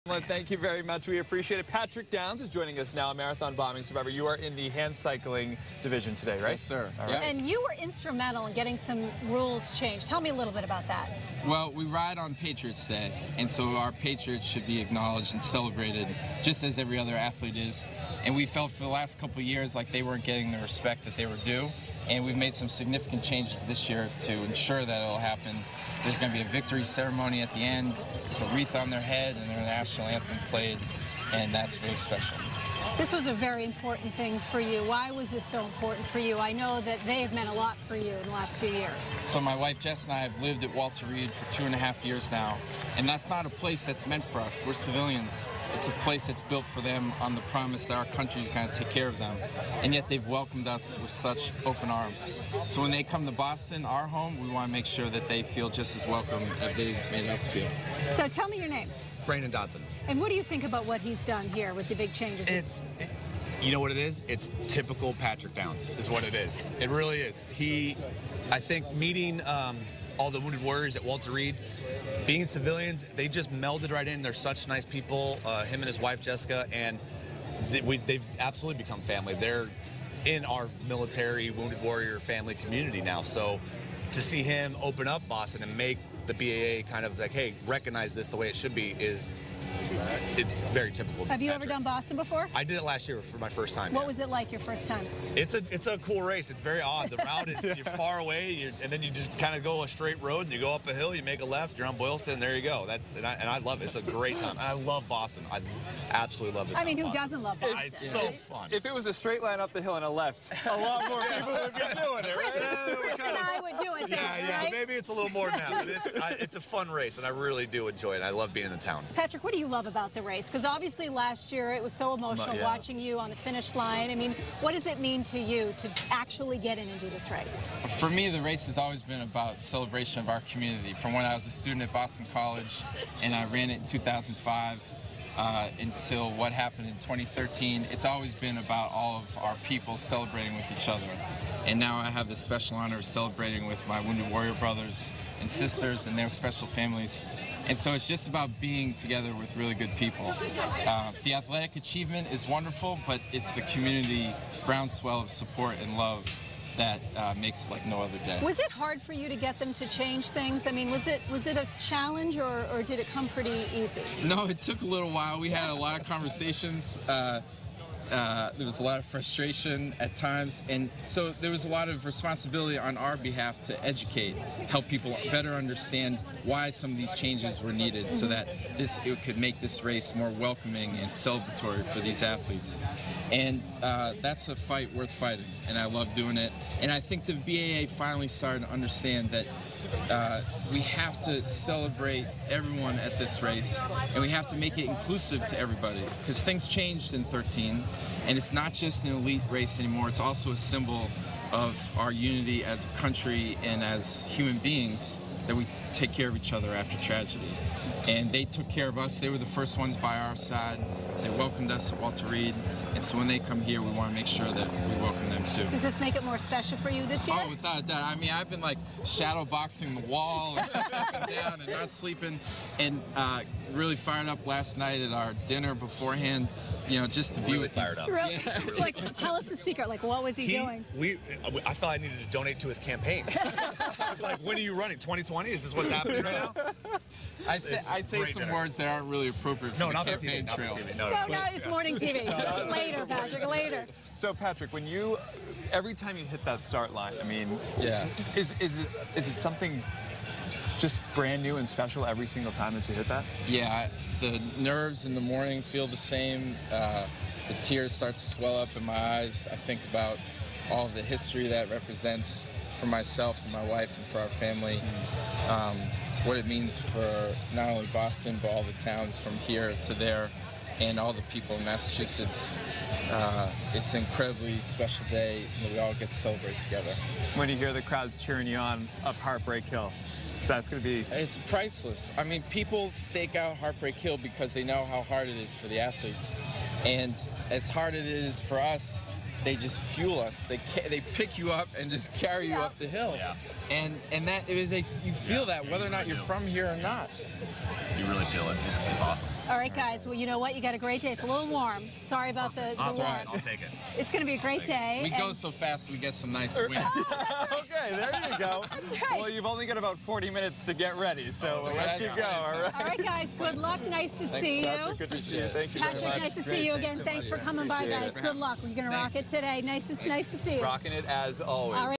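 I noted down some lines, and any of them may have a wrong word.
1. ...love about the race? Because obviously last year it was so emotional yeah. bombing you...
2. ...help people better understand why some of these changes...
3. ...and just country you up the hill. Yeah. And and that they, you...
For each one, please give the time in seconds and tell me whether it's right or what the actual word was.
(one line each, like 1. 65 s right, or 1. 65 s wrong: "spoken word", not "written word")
1. 119 s wrong: "watching", not "bombing"
2. 174 s right
3. 291 s wrong: "carry", not "country".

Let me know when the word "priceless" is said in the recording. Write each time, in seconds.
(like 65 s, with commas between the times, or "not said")
281 s.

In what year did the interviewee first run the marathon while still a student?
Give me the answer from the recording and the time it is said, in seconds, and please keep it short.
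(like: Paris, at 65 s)
2005, at 133 s.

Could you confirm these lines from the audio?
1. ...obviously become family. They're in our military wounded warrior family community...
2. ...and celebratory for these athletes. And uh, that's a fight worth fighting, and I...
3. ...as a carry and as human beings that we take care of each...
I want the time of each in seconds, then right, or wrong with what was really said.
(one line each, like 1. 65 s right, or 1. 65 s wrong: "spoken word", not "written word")
1. 78 s wrong: "absolutely", not "obviously"
2. 181 s right
3. 202 s wrong: "country", not "carry".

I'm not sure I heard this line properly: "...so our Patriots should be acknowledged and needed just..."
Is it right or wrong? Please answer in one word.
wrong.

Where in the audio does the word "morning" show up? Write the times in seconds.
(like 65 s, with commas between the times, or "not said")
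241 s, 255 s.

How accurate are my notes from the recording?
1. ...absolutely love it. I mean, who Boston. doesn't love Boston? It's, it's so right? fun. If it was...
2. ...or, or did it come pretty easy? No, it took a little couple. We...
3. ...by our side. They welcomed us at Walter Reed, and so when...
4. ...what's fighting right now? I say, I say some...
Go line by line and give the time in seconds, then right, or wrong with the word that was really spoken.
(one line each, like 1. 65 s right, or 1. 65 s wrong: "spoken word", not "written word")
1. 106 s right
2. 162 s wrong: "while", not "couple"
3. 209 s right
4. 235 s wrong: "happening", not "fighting".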